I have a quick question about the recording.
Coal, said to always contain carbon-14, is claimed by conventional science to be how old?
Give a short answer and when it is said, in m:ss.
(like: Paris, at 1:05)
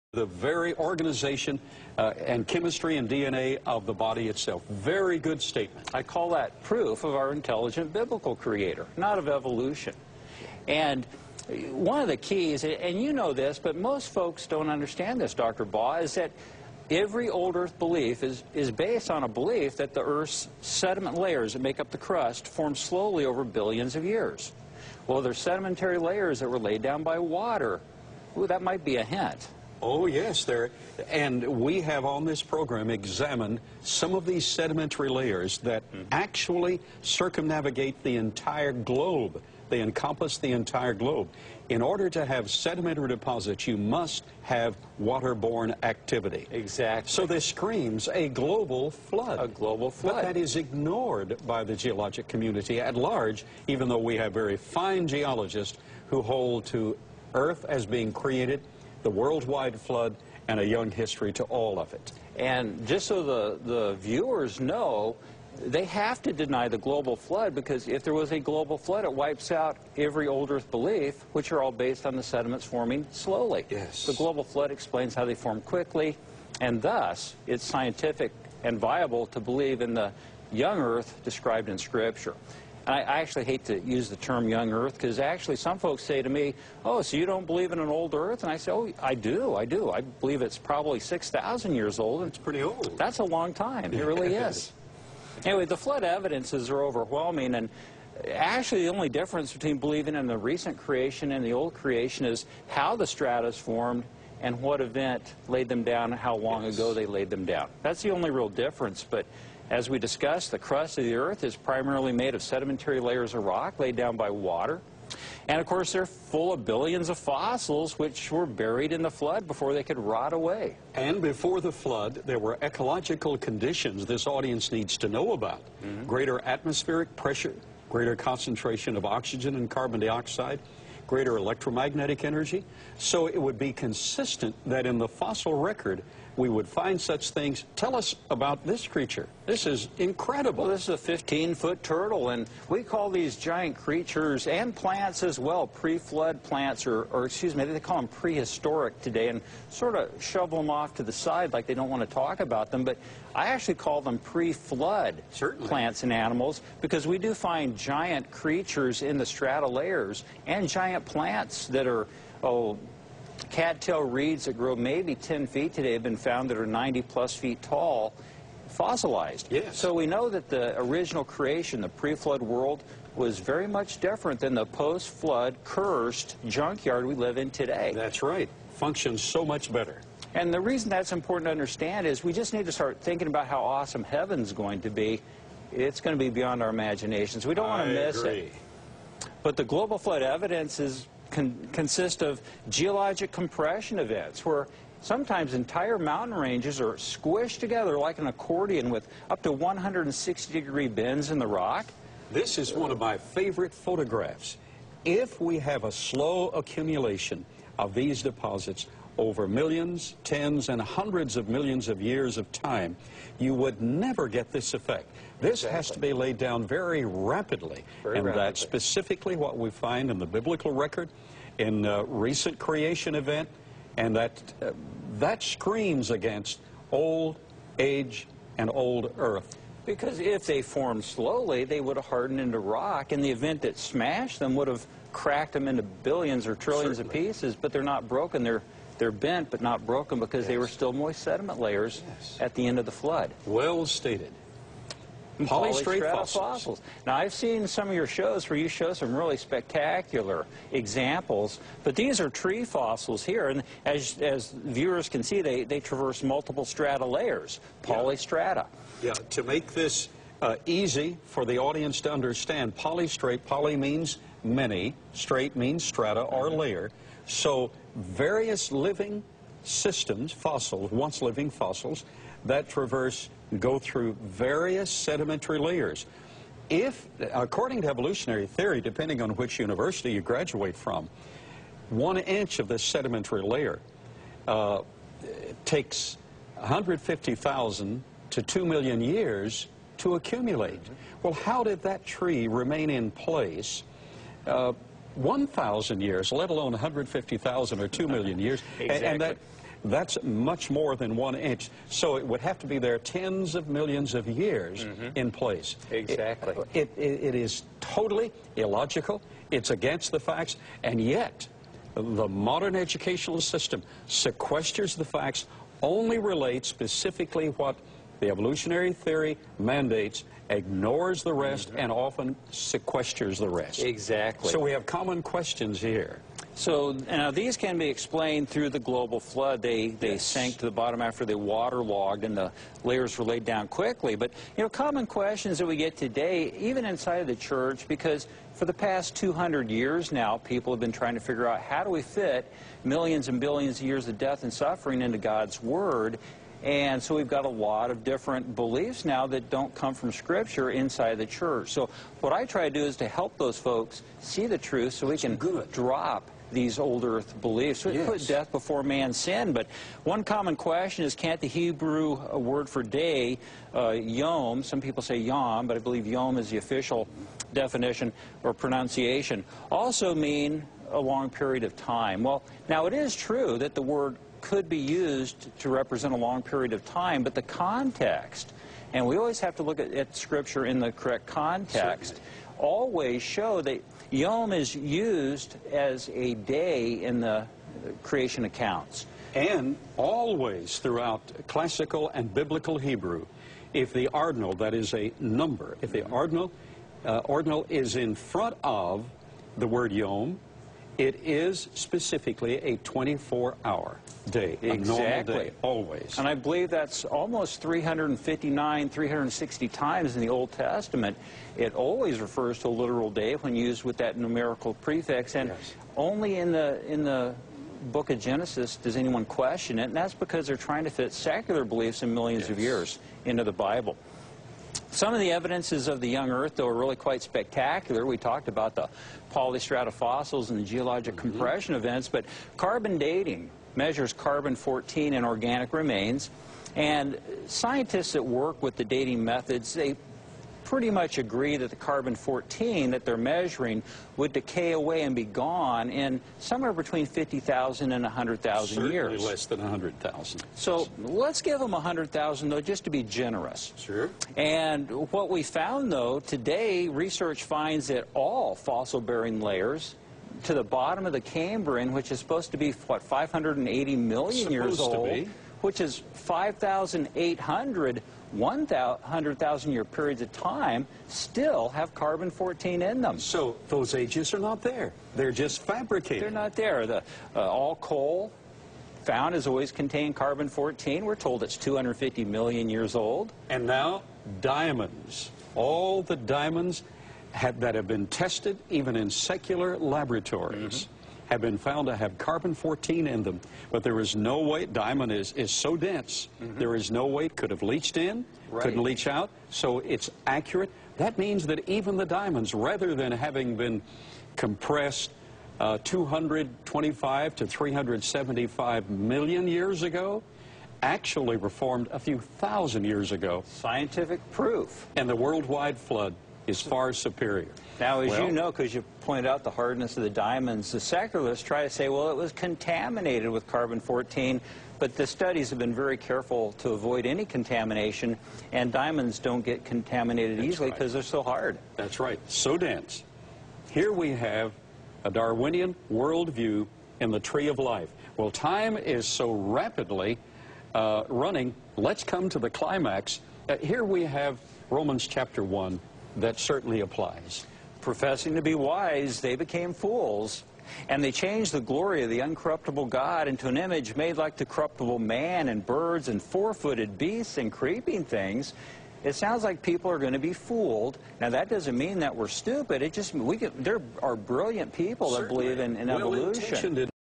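250 million years, at 8:01.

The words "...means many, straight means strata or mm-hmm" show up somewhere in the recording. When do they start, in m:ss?
4:23.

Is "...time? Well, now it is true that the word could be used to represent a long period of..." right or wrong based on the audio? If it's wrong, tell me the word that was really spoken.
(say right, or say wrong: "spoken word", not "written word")
right.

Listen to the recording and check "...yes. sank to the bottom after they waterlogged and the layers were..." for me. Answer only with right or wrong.
right.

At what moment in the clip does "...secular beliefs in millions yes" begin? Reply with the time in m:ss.
7:01.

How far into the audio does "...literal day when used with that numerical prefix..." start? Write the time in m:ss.
6:52.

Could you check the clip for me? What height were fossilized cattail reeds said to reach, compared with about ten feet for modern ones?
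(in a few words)
90 plus feet.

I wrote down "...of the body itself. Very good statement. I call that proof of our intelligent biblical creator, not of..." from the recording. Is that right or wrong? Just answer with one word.
right.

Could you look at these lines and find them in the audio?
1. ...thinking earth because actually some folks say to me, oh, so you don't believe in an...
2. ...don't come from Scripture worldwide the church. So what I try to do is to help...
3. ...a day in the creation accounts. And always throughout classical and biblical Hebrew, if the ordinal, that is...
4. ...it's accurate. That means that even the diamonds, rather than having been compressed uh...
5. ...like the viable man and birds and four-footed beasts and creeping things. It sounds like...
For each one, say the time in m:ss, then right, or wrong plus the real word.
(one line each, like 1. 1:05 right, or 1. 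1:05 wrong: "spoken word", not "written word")
1. 1:24 wrong: "young", not "thinking"
2. 5:49 wrong: "inside", not "worldwide"
3. 6:26 right
4. 8:19 right
5. 9:14 wrong: "corruptible", not "viable".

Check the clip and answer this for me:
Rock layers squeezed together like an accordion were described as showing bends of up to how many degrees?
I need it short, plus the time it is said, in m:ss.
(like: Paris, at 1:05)
160 degrees, at 3:19.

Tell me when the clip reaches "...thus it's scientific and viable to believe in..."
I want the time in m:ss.
1:16.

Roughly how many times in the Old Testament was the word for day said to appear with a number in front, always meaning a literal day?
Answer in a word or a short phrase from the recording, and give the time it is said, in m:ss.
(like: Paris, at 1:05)
360, at 6:48.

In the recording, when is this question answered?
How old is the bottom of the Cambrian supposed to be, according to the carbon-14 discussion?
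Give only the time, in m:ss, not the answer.
7:43.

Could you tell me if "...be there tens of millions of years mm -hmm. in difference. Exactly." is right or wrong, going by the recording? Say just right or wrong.
wrong.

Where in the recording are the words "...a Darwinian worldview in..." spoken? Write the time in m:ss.
8:55.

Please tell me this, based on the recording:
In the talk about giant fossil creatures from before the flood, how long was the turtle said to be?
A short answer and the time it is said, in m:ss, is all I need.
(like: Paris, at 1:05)
15-foot, at 2:21.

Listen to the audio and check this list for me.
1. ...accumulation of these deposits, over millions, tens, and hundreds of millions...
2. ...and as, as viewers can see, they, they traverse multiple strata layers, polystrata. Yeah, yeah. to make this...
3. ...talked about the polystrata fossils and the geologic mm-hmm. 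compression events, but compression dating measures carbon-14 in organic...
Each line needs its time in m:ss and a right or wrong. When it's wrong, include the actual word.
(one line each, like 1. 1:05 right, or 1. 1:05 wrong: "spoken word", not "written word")
1. 3:26 right
2. 4:13 right
3. 7:08 wrong: "carbon", not "compression".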